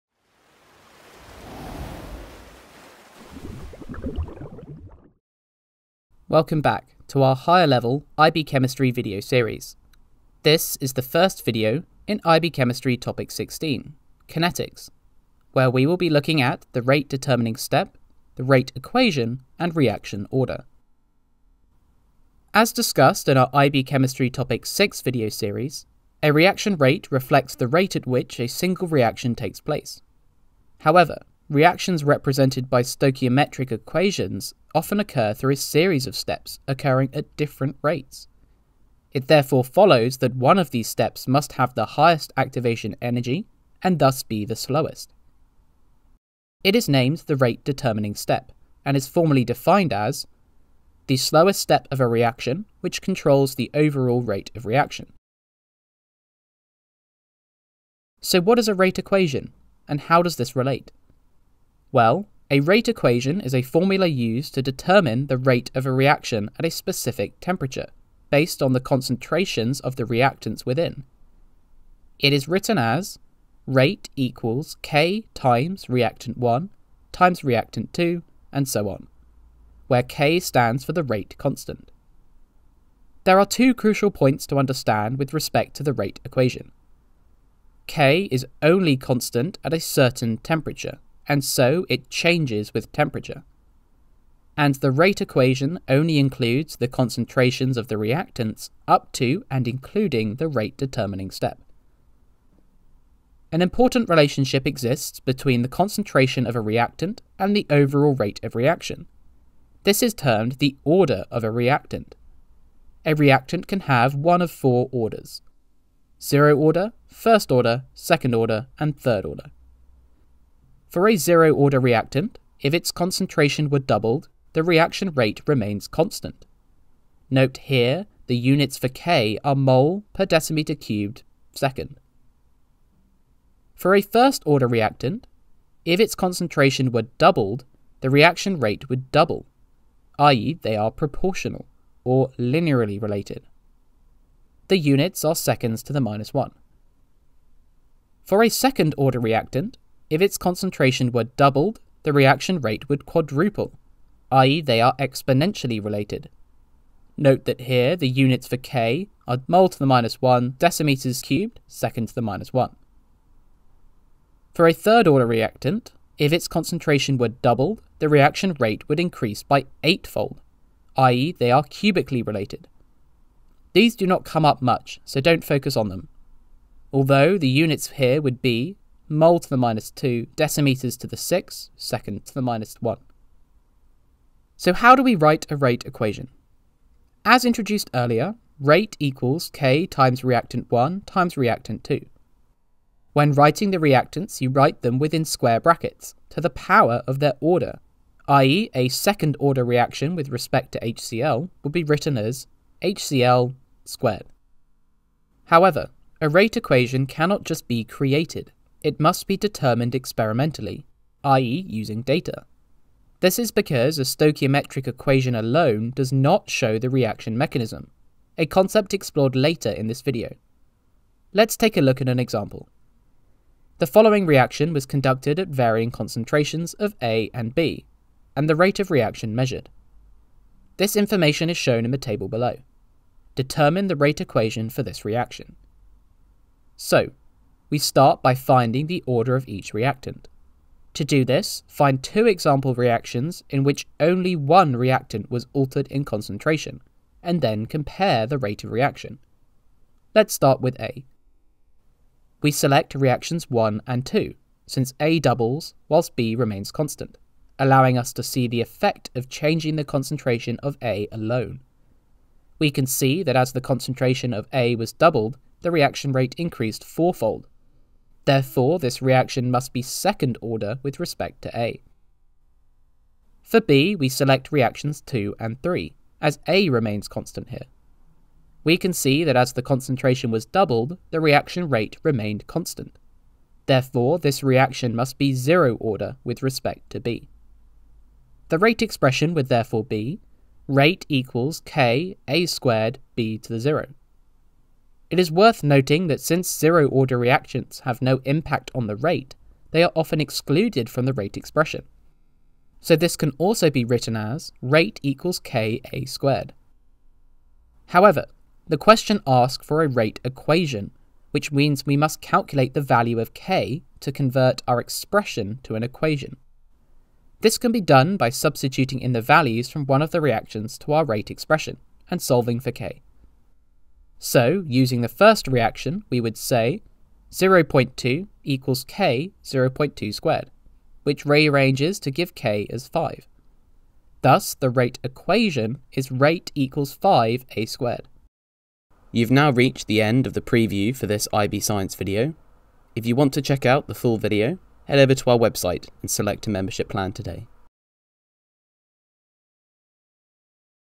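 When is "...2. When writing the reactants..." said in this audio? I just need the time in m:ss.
3:11.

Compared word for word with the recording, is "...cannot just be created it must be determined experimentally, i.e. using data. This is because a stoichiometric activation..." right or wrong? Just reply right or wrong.
wrong.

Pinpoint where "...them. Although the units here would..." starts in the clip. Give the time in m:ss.
2:55.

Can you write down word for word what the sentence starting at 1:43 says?
An important relationship exists between the concentration of a reactant and the overall rate of reaction.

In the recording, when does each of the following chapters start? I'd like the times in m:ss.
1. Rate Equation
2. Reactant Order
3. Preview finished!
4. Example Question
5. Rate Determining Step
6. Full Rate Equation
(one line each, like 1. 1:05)
1. 0:57
2. 1:50
3. 5:39
4. 3:41
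5. 0:23
6. 3:27.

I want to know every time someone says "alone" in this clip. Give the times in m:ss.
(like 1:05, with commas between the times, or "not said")
3:35, 4:21.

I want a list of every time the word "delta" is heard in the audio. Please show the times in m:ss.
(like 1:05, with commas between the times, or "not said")
not said.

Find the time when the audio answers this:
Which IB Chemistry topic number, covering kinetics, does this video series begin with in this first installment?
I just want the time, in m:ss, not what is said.
0:12.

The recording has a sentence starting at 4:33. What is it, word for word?
For B, we select reactions 2 and 3, as A remains constant here.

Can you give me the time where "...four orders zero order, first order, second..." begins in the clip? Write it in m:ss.
1:54.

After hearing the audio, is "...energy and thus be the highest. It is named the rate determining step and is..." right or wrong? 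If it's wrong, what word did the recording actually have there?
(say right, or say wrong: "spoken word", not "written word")
wrong: "slowest", not "highest".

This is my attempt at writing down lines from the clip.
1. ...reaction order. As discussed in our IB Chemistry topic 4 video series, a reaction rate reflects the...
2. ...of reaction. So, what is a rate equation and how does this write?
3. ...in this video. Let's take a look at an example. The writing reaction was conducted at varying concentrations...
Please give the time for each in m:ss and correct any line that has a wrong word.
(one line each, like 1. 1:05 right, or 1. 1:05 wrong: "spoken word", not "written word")
1. 0:19 wrong: "6", not "4"
2. 0:54 wrong: "relate", not "write"
3. 3:39 wrong: "following", not "writing".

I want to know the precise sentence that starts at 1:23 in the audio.
There are two crucial points to understand with respect to the rate equation.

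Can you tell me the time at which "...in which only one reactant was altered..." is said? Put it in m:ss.
4:03.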